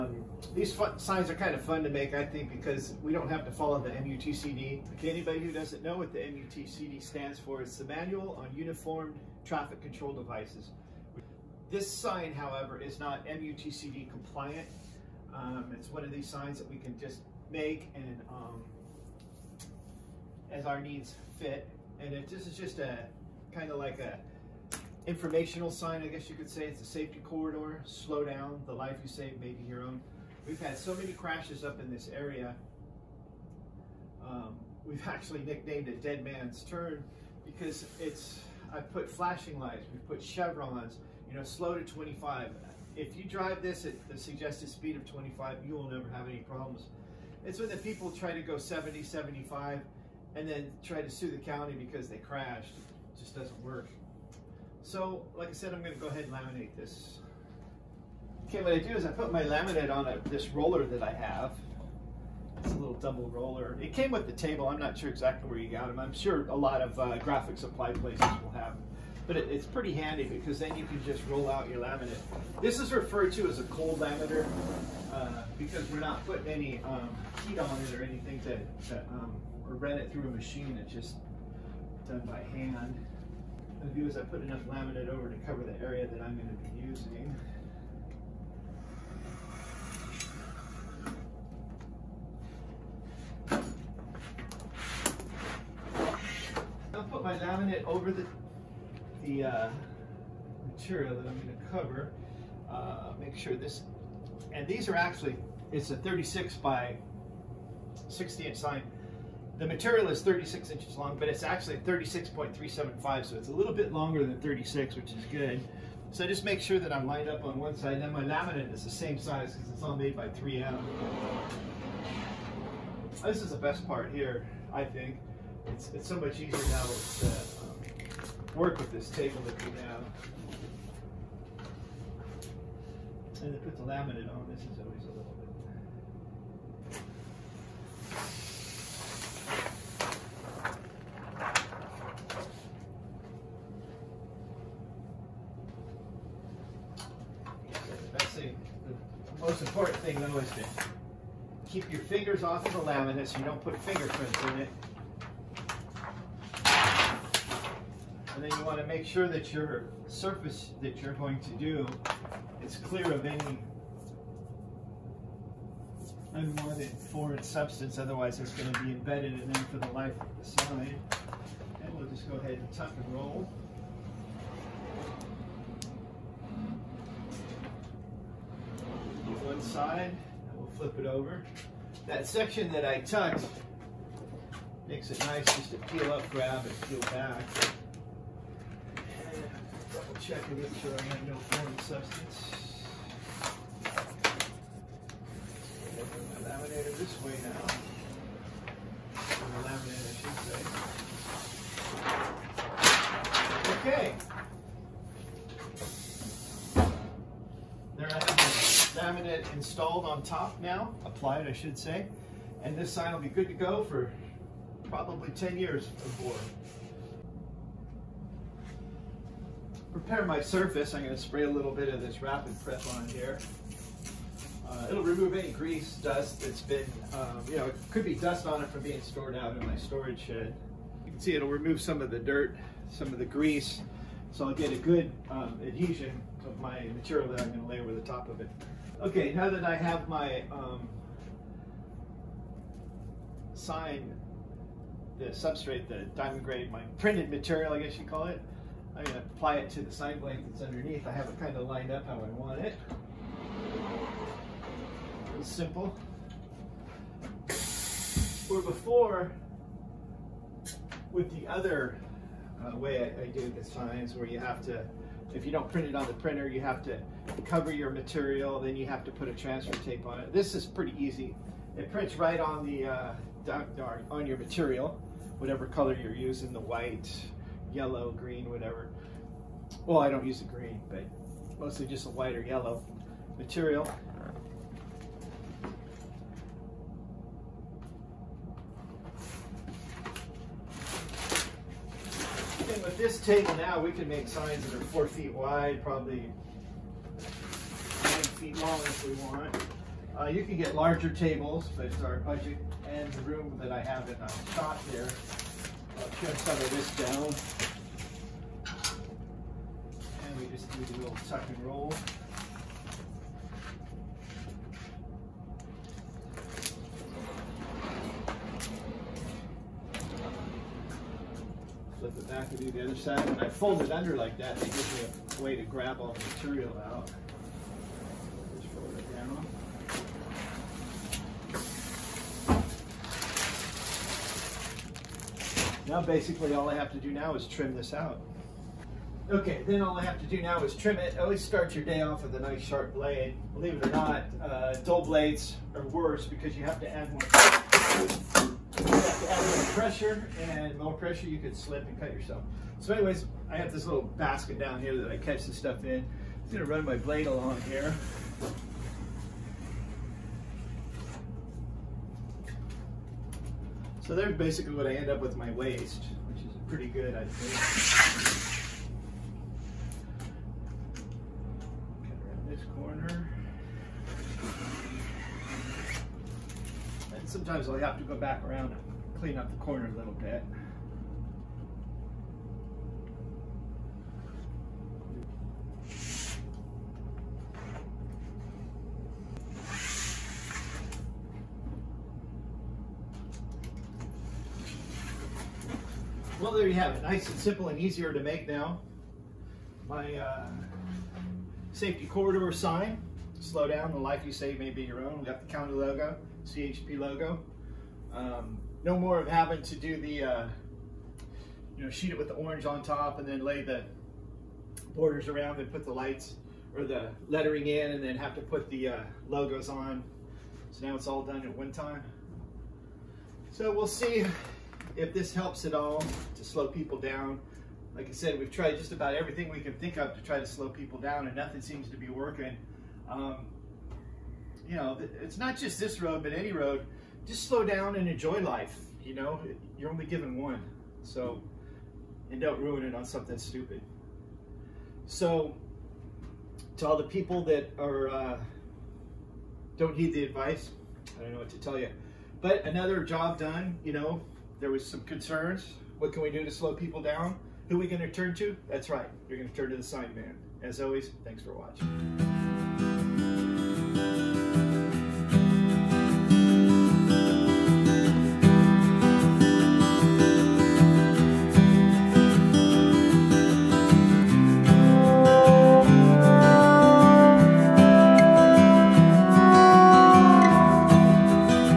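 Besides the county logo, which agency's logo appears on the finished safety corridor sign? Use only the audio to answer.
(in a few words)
CHP.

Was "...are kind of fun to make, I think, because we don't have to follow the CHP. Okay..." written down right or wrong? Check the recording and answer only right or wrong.
wrong.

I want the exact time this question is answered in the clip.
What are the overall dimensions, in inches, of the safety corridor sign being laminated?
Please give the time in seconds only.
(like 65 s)
105 s.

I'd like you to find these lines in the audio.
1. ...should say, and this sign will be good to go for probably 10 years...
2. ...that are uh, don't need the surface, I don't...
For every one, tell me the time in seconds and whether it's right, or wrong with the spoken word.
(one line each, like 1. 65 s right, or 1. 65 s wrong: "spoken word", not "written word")
1. 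211 s right
2. 447 s wrong: "advice", not "surface".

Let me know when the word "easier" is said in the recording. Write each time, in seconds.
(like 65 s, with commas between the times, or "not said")
126 s, 397 s.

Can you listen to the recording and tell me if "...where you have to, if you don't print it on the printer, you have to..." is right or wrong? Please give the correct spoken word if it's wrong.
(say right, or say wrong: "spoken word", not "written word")
right.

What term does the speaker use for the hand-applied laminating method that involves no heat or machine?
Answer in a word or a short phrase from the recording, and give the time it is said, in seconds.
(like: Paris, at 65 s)
cold laminator, at 73 s.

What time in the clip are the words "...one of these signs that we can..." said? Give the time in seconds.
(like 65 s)
15 s.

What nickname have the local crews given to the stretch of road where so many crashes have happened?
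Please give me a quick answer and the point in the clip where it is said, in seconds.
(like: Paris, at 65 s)
Dead Man's Turn, at 36 s.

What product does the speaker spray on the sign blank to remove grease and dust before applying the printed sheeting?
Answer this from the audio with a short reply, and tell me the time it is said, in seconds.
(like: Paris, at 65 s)
Rapid Prep, at 222 s.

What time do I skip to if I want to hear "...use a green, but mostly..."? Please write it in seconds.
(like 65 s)
280 s.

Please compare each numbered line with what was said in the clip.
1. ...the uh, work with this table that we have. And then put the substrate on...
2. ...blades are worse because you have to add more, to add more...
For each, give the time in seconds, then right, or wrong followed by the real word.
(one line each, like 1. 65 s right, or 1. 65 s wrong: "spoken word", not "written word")
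1. 127 s wrong: "laminate", not "substrate"
2. 345 s right.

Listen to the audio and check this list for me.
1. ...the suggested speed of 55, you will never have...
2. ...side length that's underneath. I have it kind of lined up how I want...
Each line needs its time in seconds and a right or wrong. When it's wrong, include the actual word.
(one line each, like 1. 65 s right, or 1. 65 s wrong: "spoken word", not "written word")
1. 44 s wrong: "25", not "55"
2. 249 s right.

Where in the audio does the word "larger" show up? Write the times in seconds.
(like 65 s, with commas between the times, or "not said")
300 s.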